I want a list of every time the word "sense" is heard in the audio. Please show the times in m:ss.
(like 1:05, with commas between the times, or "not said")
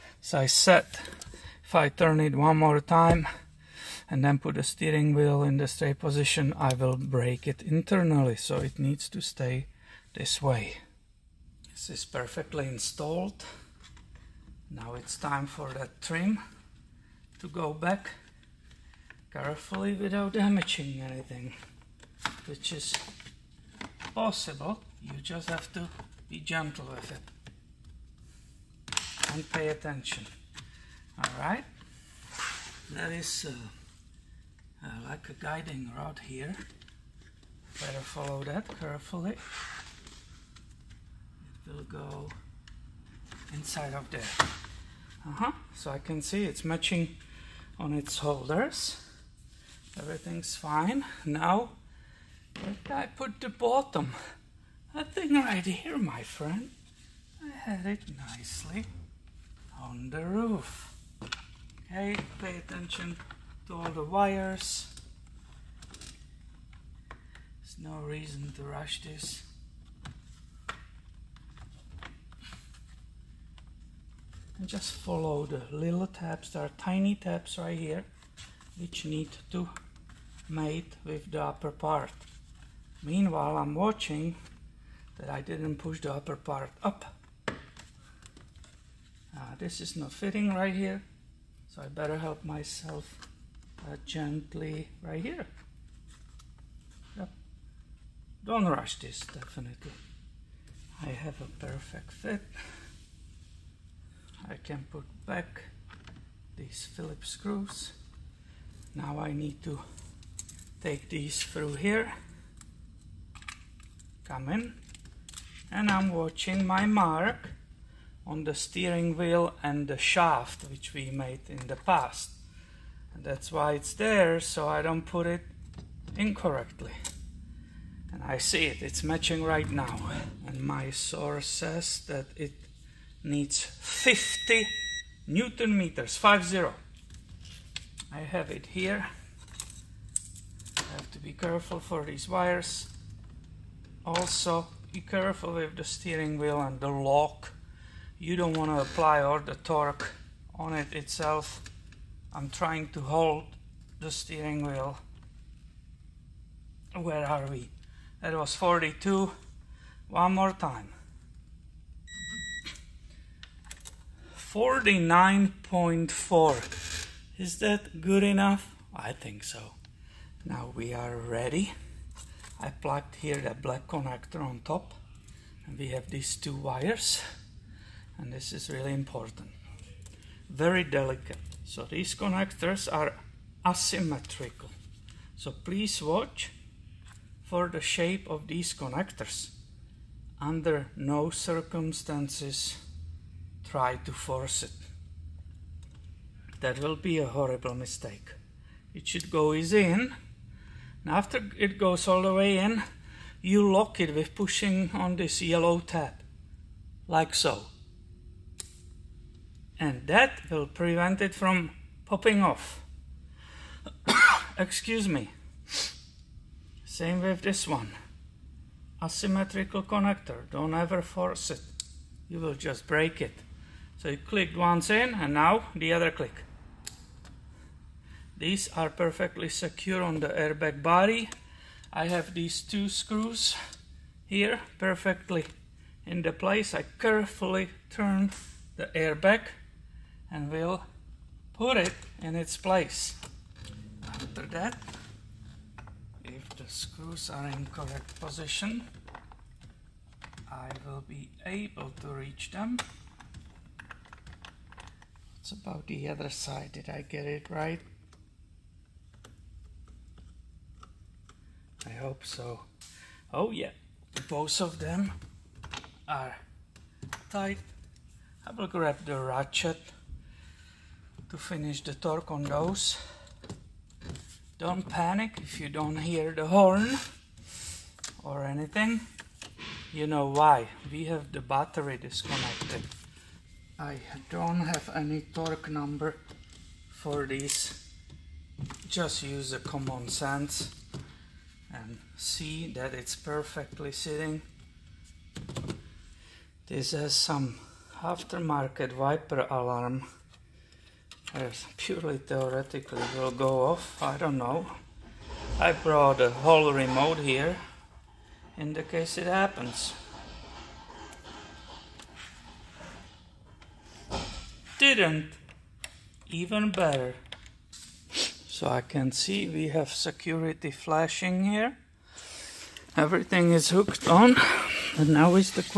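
4:50.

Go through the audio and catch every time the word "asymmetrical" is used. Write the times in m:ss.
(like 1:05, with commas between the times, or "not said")
3:03, 3:39.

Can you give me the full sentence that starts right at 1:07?
There's no reason to rush this.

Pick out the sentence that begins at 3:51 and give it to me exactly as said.
I have these two screws here perfectly in the place.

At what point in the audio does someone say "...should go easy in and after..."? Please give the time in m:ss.
3:19.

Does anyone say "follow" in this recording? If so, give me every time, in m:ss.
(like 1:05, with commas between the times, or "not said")
0:37, 1:14.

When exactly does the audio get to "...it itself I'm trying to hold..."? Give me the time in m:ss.
2:30.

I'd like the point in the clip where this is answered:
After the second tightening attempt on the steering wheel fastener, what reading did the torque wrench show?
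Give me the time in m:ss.
2:44.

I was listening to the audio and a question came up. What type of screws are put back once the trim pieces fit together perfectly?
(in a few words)
Phillips.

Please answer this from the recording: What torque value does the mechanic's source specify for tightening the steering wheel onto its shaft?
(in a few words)
50 newton meters.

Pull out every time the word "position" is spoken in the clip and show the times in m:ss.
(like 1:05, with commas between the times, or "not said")
0:05, 4:08.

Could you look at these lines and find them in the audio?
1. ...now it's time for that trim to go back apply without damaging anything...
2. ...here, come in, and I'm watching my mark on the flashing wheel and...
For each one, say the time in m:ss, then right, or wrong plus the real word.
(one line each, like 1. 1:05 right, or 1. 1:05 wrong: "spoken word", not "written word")
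1. 0:14 wrong: "carefully", not "apply"
2. 1:51 wrong: "steering", not "flashing".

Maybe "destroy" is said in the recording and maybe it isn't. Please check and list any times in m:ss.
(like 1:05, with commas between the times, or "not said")
not said.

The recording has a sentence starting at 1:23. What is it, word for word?
Meanwhile, I'm watching that I didn't push the upper part up.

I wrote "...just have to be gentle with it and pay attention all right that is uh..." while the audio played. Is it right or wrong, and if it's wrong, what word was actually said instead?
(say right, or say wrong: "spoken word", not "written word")
right.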